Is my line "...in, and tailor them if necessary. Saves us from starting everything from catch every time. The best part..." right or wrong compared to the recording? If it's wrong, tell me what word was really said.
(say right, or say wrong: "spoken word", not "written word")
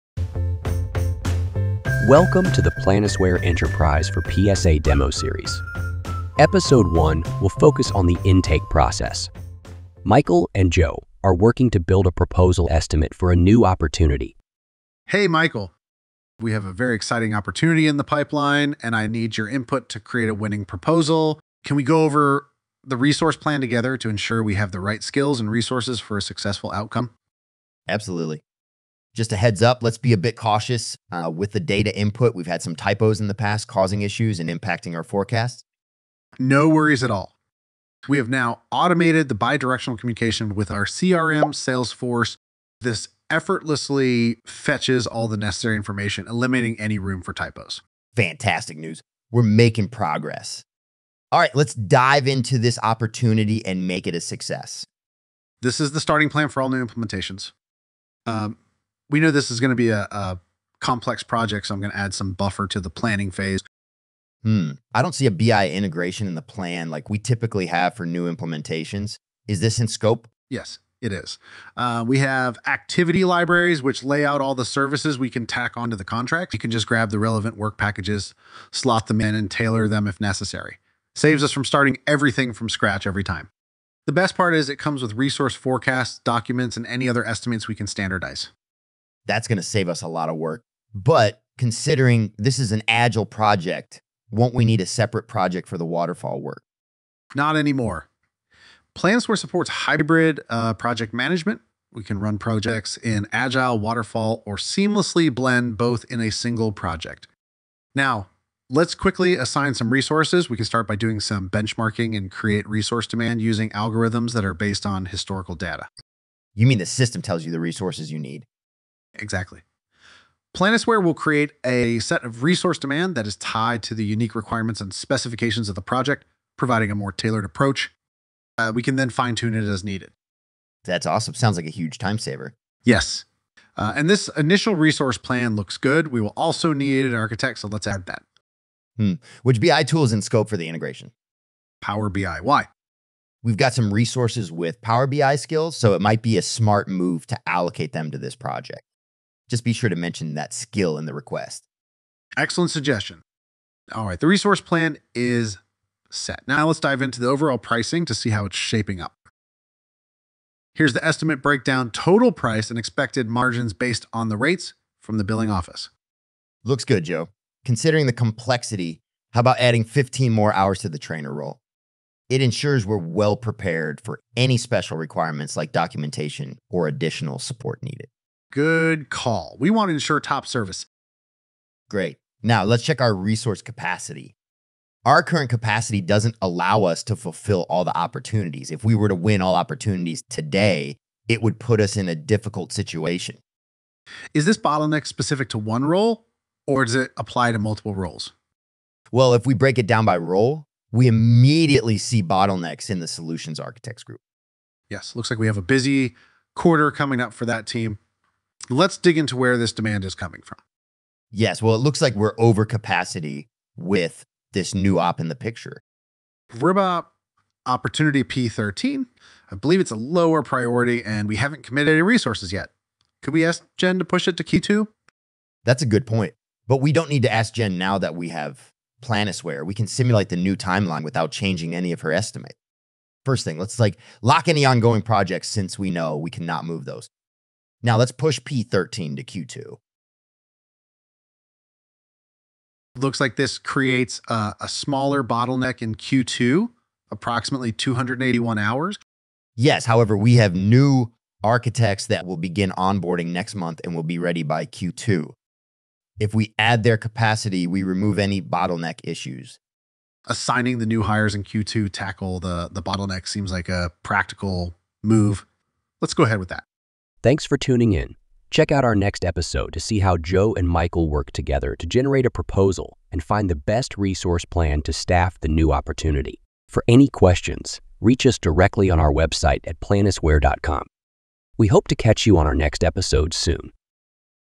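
wrong: "scratch", not "catch".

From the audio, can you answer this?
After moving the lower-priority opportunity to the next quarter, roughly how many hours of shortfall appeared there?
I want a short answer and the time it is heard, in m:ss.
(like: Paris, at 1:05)
281, at 4:07.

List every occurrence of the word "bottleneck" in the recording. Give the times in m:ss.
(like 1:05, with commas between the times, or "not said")
3:14, 3:22, 4:05, 4:18, 4:22.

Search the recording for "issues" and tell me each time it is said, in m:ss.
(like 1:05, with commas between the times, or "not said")
0:34, 4:19.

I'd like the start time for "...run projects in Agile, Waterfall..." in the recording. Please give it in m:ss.
1:42.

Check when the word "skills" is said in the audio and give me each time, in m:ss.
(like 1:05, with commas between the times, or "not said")
0:25, 2:25, 2:30.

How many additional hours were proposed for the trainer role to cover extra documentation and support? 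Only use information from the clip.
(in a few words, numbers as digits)
15.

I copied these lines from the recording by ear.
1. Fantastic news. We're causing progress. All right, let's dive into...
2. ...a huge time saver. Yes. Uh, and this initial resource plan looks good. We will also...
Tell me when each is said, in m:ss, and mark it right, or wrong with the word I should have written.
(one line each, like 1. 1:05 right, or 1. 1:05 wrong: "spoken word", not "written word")
1. 0:48 wrong: "making", not "causing"
2. 2:11 right.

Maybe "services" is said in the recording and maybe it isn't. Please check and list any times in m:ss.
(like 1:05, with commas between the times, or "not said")
1:14, 3:00.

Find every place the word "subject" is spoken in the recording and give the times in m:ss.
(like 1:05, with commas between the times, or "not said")
not said.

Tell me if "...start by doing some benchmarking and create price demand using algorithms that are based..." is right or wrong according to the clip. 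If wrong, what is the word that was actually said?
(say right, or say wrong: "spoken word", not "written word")
wrong: "resource", not "price".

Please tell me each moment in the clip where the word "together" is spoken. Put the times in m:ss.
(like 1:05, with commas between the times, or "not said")
0:23, 4:31.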